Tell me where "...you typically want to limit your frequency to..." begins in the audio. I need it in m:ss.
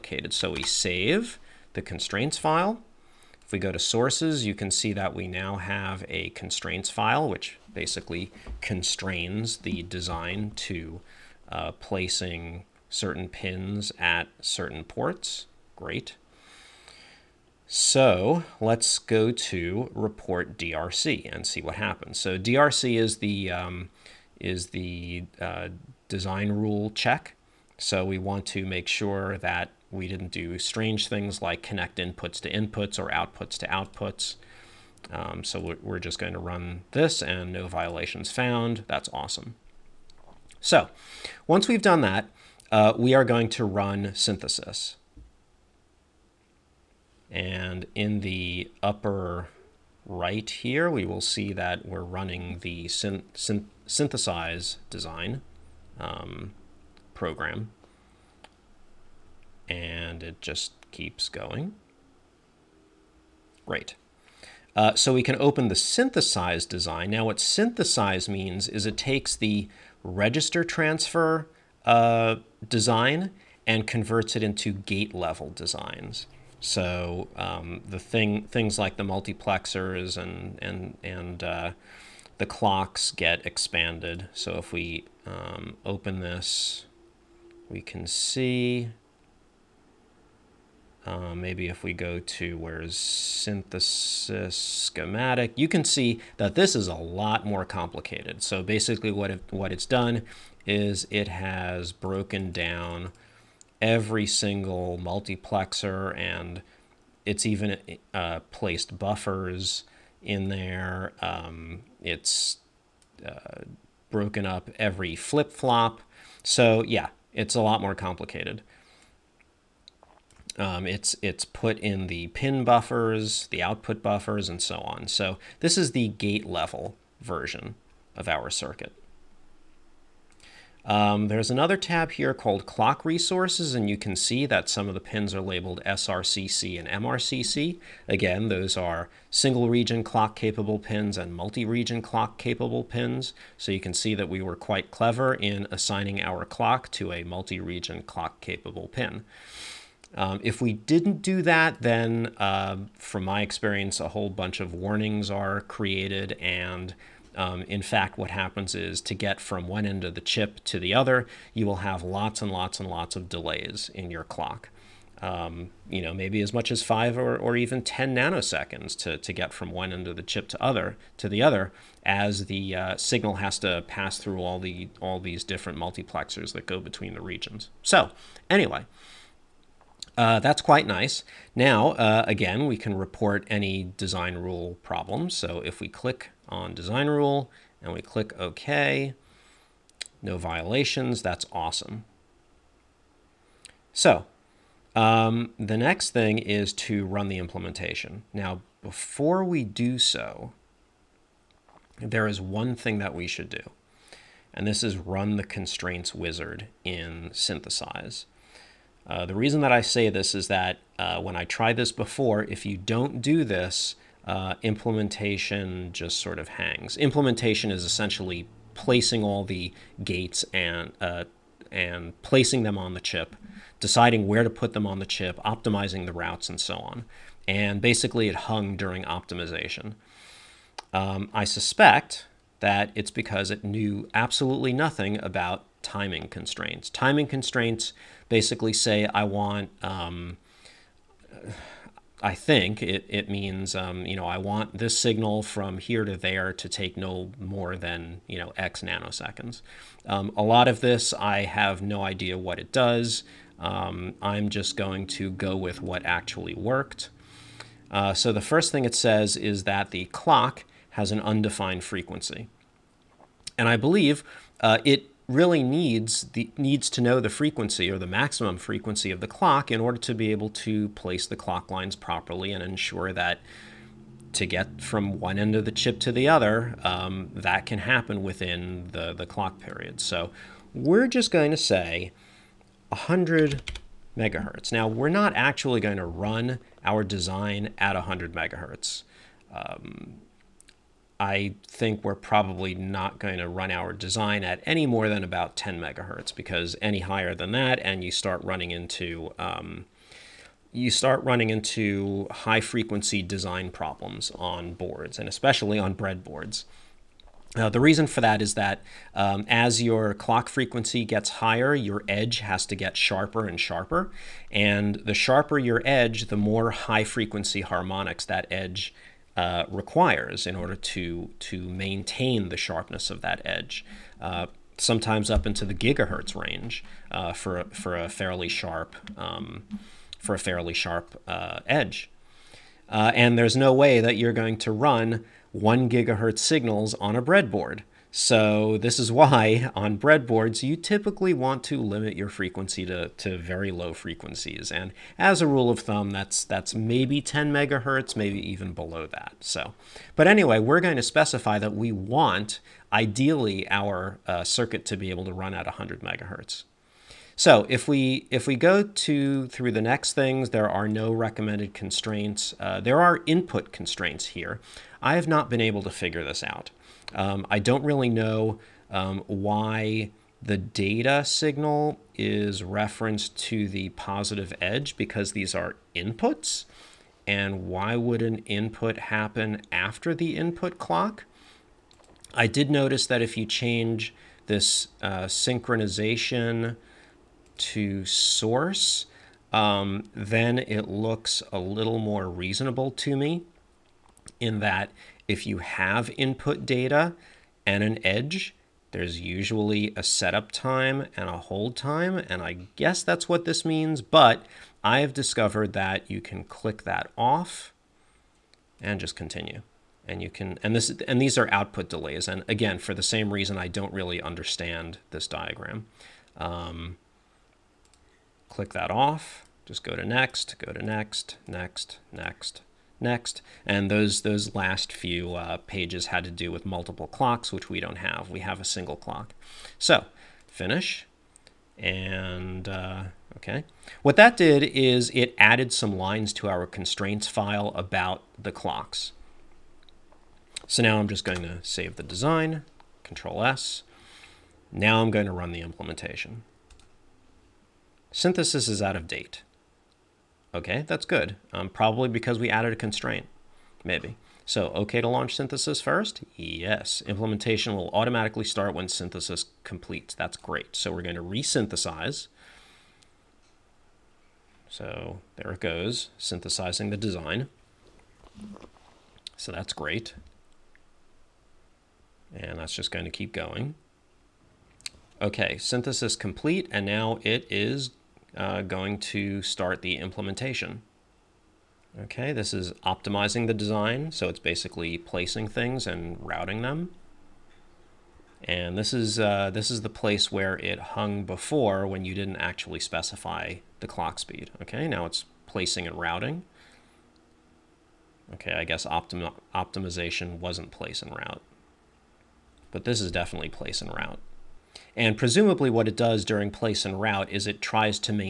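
5:40.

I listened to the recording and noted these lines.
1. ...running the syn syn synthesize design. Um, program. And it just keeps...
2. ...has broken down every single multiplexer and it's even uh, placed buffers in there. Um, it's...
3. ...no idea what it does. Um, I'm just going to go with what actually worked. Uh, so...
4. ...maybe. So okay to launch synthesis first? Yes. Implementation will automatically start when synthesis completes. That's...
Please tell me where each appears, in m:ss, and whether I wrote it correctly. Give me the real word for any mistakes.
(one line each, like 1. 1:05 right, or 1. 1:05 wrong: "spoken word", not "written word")
1. 0:51 right
2. 1:41 right
3. 4:11 right
4. 7:33 right.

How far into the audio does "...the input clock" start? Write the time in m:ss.
6:20.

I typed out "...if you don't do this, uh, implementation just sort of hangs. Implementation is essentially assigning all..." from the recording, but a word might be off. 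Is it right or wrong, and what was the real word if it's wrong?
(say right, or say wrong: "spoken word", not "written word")
wrong: "placing", not "assigning".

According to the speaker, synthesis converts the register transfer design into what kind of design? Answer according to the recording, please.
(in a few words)
Gate level designs.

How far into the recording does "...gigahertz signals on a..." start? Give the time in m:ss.
5:35.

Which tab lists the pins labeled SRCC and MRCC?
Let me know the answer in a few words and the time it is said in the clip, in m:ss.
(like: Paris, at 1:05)
Clock Resources, at 2:12.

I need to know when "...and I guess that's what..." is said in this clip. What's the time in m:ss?
6:42.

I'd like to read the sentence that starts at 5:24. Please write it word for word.
Uh, sometimes up into the gigahertz range uh, for for a fairly sharp um, for a fairly sharp uh, edge.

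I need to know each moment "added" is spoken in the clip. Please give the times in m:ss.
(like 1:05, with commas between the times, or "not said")
7:15, 7:32.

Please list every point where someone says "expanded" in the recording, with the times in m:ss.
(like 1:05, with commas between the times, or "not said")
1:23.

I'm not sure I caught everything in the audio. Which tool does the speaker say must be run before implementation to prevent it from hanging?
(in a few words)
Constraints wizard.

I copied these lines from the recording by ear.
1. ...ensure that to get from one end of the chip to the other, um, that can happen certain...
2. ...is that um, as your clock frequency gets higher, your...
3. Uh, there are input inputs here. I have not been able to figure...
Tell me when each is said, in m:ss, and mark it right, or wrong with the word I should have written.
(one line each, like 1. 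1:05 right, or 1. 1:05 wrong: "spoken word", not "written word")
1. 4:32 wrong: "within", not "certain"
2. 5:08 right
3. 6:02 wrong: "constraints", not "inputs".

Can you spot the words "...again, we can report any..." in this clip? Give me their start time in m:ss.
3:02.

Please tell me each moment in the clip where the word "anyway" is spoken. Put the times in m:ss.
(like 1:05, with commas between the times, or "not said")
2:58, 5:50.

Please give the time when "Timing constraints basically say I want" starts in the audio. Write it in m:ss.
3:56.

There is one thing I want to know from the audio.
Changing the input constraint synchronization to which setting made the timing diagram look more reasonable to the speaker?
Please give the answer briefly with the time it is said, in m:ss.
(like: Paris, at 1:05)
Source, at 6:28.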